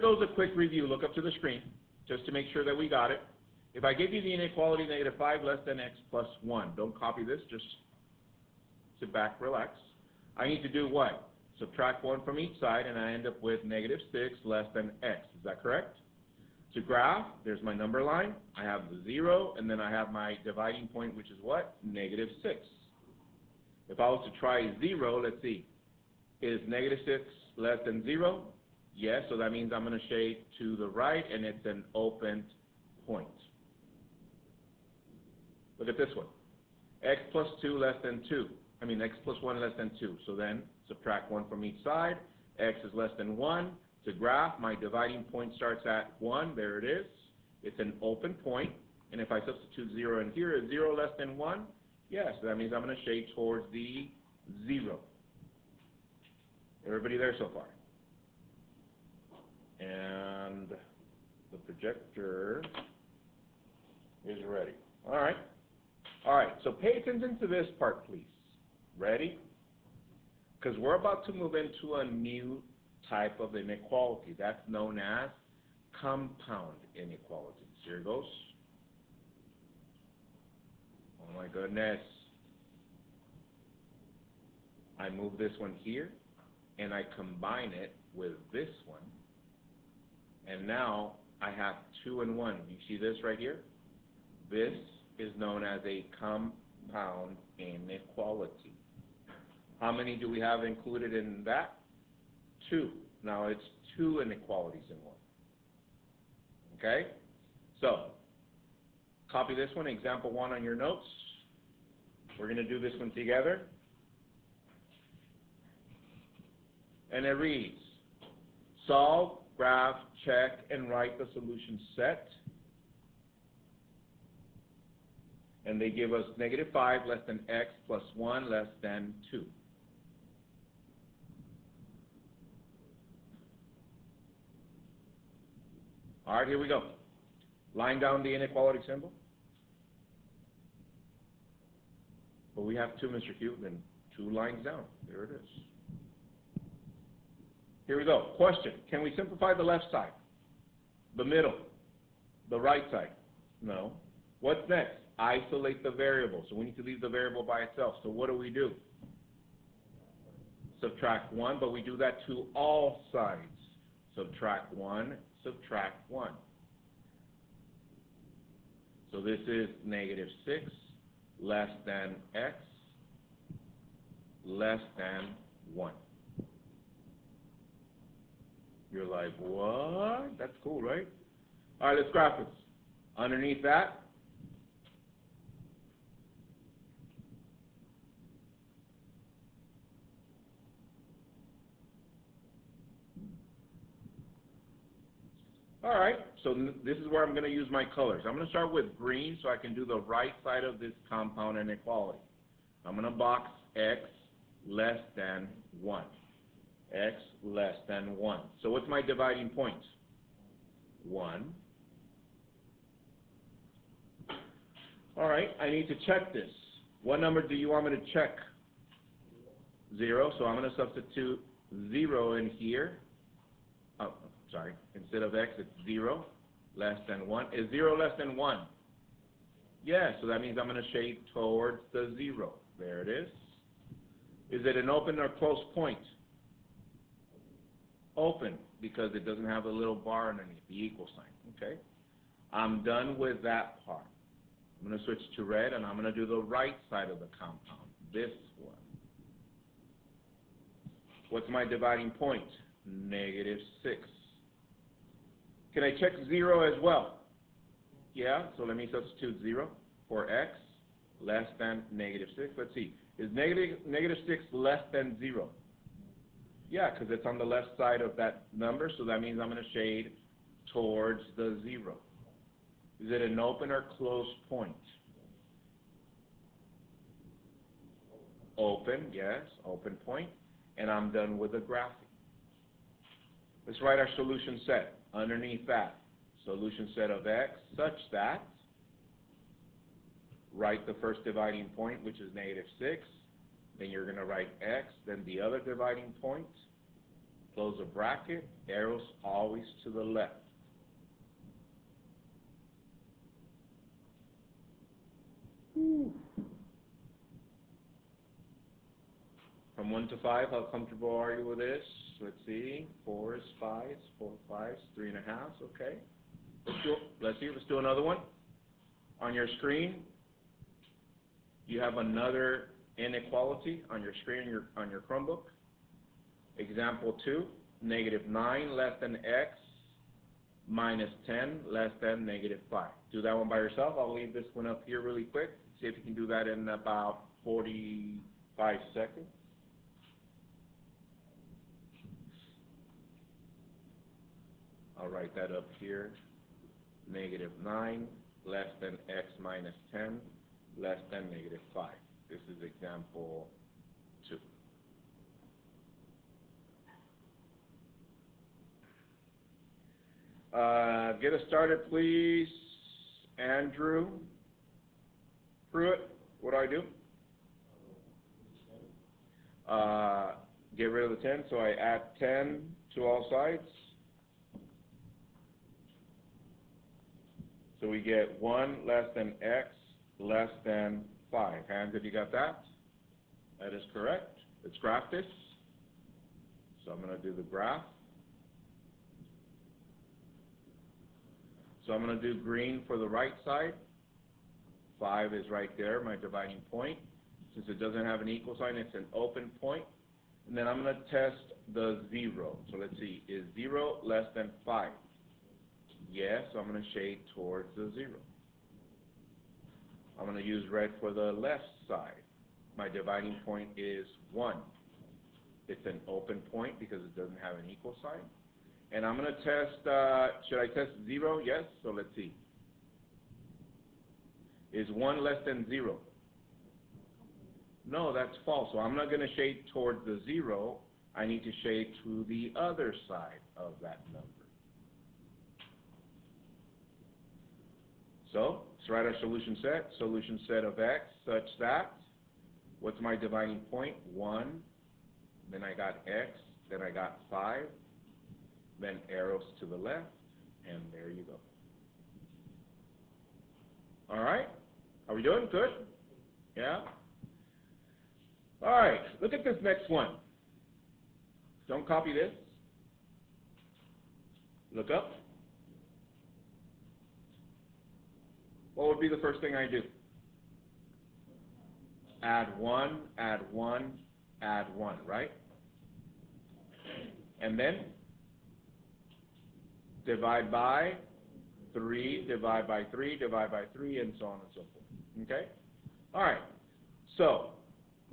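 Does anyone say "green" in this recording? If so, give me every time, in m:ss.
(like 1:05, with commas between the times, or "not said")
3:18, 6:32.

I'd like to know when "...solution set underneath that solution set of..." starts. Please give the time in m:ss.
4:44.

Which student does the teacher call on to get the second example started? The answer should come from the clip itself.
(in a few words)
Andrew Pruitt.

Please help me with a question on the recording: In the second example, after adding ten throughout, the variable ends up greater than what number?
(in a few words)
1.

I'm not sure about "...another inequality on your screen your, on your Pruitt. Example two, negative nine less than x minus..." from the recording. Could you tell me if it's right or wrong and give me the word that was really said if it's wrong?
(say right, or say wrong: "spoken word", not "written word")
wrong: "Chromebook", not "Pruitt".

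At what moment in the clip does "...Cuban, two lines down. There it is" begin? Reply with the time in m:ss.
2:23.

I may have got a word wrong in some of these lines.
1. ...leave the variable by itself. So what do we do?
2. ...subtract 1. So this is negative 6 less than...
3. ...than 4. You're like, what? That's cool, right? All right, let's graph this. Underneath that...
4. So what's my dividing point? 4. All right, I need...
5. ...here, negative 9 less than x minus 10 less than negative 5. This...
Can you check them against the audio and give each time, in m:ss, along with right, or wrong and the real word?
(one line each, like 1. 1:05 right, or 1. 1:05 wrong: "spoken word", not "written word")
1. 2:36 right
2. 2:45 right
3. 2:54 wrong: "1", not "4"
4. 3:28 wrong: "1", not "4"
5. 5:45 right.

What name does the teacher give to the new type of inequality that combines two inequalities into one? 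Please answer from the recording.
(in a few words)
compound inequalities.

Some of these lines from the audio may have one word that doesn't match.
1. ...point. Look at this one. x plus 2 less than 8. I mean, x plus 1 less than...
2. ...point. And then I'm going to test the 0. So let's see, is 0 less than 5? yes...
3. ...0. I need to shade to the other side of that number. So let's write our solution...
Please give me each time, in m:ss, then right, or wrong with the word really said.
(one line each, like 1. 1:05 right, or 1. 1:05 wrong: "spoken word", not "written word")
1. 0:33 wrong: "2", not "8"
2. 6:39 right
3. 7:10 right.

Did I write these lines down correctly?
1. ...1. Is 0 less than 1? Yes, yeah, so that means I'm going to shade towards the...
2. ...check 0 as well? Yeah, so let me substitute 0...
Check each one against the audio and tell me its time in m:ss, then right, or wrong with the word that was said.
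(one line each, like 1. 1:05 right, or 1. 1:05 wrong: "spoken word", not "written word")
1. 3:47 right
2. 4:15 right.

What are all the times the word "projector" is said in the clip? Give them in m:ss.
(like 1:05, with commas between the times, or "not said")
1:01.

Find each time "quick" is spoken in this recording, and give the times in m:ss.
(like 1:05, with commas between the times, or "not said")
0:00, 5:35.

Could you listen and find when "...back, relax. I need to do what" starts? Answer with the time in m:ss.
0:09.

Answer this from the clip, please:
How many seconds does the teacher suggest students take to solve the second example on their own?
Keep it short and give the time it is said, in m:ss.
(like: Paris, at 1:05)
45, at 5:37.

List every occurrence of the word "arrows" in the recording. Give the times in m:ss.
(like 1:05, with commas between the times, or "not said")
4:58, 7:29.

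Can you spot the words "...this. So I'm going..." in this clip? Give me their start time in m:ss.
6:25.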